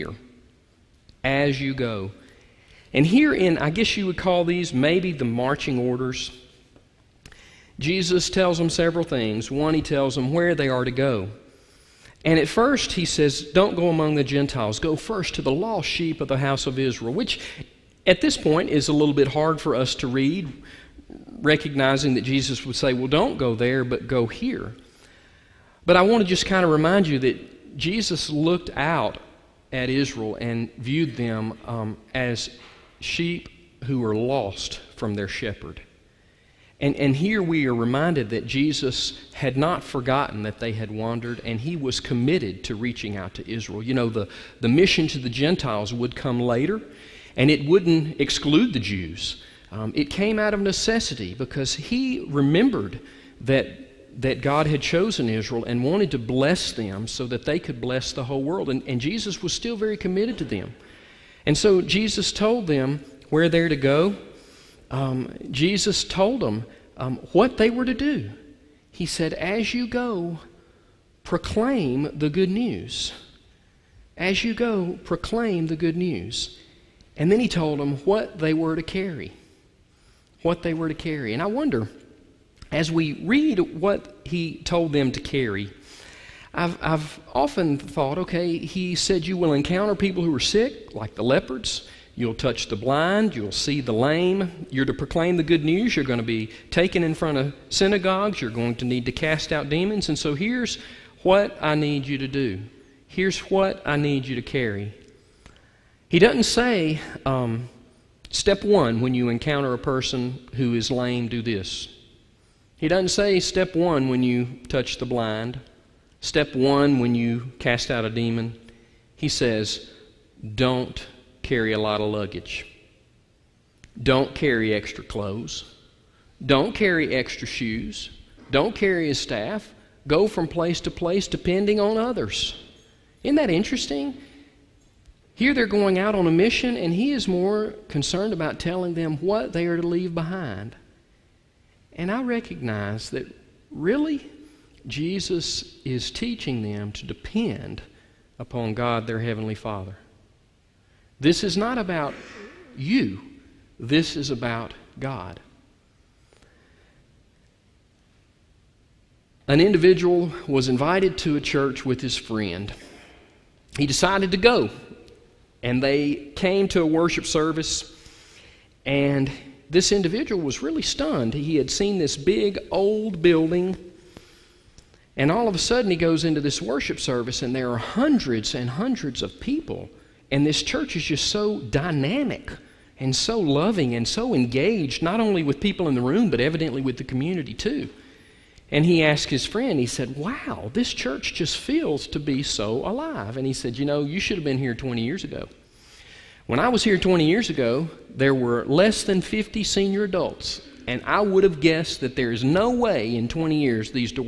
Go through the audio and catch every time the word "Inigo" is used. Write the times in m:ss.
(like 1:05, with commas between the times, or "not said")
not said.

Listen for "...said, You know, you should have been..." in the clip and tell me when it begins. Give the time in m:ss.
3:13.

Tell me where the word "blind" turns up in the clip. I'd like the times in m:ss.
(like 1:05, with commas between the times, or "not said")
1:32, 1:55.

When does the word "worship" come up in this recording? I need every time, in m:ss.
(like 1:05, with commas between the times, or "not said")
2:46, 2:56.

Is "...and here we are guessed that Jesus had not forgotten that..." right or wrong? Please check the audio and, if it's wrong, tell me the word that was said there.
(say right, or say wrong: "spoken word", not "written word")
wrong: "reminded", not "guessed".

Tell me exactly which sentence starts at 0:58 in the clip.
And, and Jesus was still very committed to them.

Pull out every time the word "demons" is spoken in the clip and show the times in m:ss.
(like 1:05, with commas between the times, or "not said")
1:39, 1:58.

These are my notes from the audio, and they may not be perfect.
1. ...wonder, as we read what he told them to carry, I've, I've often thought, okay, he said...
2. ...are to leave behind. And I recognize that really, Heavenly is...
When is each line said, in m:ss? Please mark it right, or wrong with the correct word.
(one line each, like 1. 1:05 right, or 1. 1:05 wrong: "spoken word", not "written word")
1. 1:21 right
2. 2:19 wrong: "Jesus", not "Heavenly".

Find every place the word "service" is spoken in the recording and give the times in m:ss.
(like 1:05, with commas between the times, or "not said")
2:47, 2:56.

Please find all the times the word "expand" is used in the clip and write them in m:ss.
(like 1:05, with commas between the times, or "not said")
not said.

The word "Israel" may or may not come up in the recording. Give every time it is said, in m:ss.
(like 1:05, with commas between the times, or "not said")
0:16, 0:29, 0:43, 0:55.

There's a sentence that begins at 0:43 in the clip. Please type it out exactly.
You know, the, the mission to the Gentiles would come later, and it wouldn't exclude the Jews.